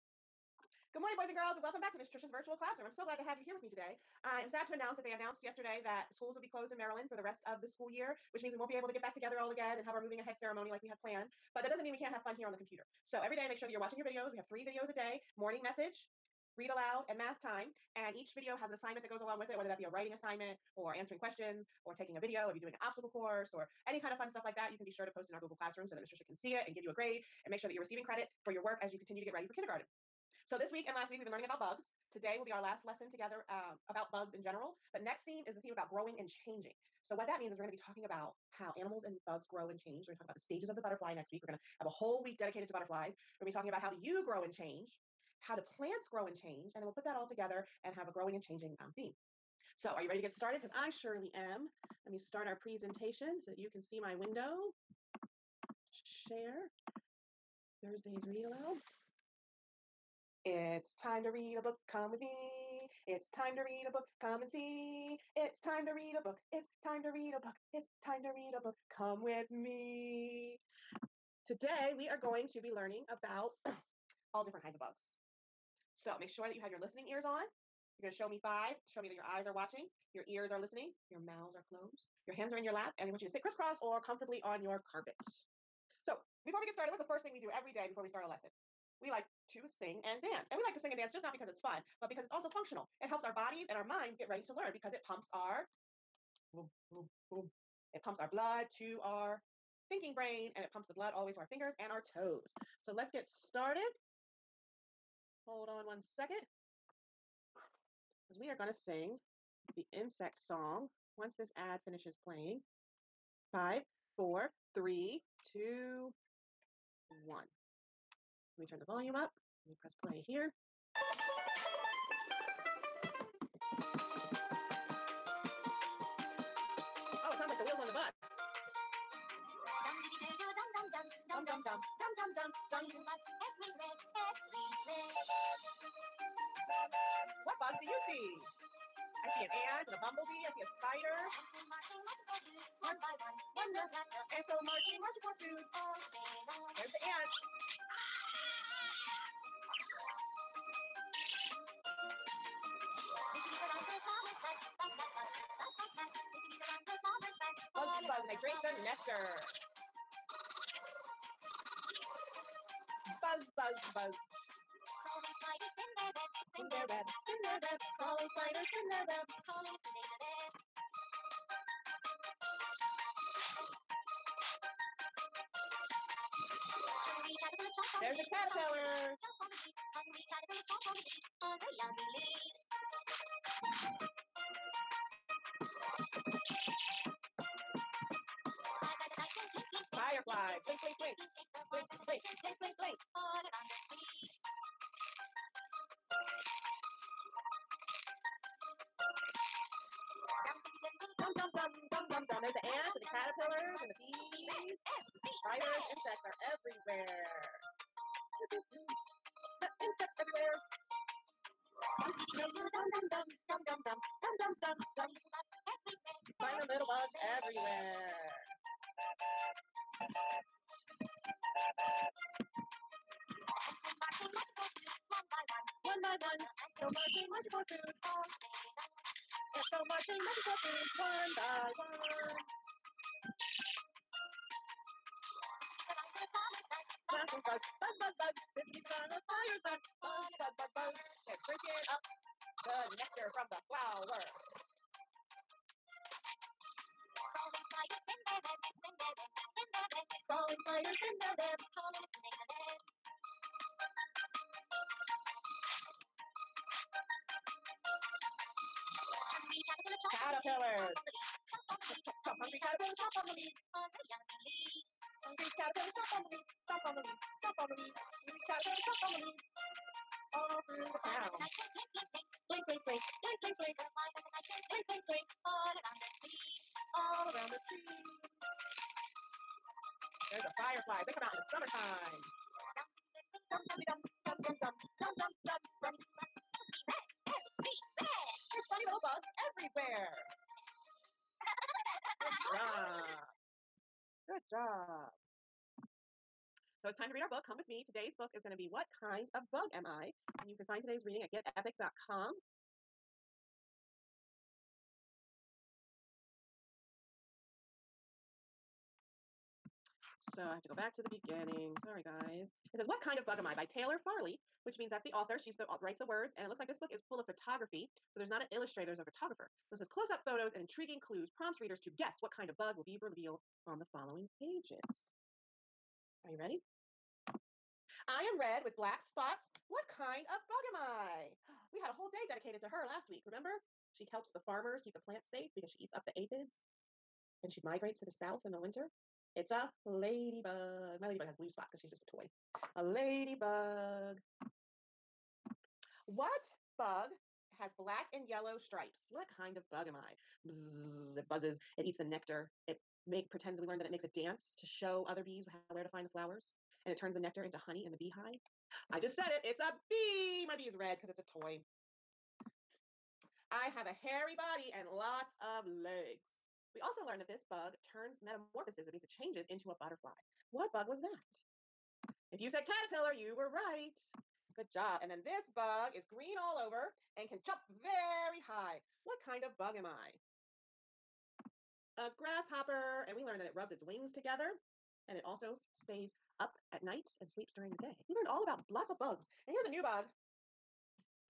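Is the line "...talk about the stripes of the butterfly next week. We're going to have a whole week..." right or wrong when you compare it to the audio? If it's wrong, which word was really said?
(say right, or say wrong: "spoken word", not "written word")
wrong: "stages", not "stripes".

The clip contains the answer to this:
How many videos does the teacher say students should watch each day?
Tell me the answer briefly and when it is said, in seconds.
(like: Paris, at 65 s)
3, at 14 s.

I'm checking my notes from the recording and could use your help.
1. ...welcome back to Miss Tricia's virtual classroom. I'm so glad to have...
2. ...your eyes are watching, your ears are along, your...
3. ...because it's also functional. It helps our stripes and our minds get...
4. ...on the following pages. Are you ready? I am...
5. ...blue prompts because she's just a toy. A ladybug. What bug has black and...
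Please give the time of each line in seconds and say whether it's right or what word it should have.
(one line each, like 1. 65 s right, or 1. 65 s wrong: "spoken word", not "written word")
1. 1 s right
2. 79 s wrong: "listening", not "along"
3. 92 s wrong: "bodies", not "stripes"
4. 323 s right
5. 341 s wrong: "spots", not "prompts".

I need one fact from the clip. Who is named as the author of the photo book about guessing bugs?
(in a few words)
Taylor Farley.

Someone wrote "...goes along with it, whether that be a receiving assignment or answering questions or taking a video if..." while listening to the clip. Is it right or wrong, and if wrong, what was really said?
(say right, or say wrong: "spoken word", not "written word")
wrong: "writing", not "receiving".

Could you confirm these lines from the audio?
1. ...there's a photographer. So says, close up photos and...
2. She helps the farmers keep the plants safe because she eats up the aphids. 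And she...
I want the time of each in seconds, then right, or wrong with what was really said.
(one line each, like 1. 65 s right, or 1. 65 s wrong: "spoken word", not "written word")
1. 318 s right
2. 333 s right.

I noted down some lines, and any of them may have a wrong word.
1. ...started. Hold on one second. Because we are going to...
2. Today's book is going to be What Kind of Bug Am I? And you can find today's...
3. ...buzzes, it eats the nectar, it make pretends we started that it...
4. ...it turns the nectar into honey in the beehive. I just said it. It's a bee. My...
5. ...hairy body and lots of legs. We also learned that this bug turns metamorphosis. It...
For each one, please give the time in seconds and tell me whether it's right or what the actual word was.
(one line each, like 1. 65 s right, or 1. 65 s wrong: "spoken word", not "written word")
1. 103 s right
2. 297 s right
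3. 351 s wrong: "learned", not "started"
4. 356 s right
5. 363 s right.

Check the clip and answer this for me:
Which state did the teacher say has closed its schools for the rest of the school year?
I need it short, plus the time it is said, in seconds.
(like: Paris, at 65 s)
Maryland, at 6 s.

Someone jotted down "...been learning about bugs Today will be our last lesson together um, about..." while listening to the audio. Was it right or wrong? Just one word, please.
right.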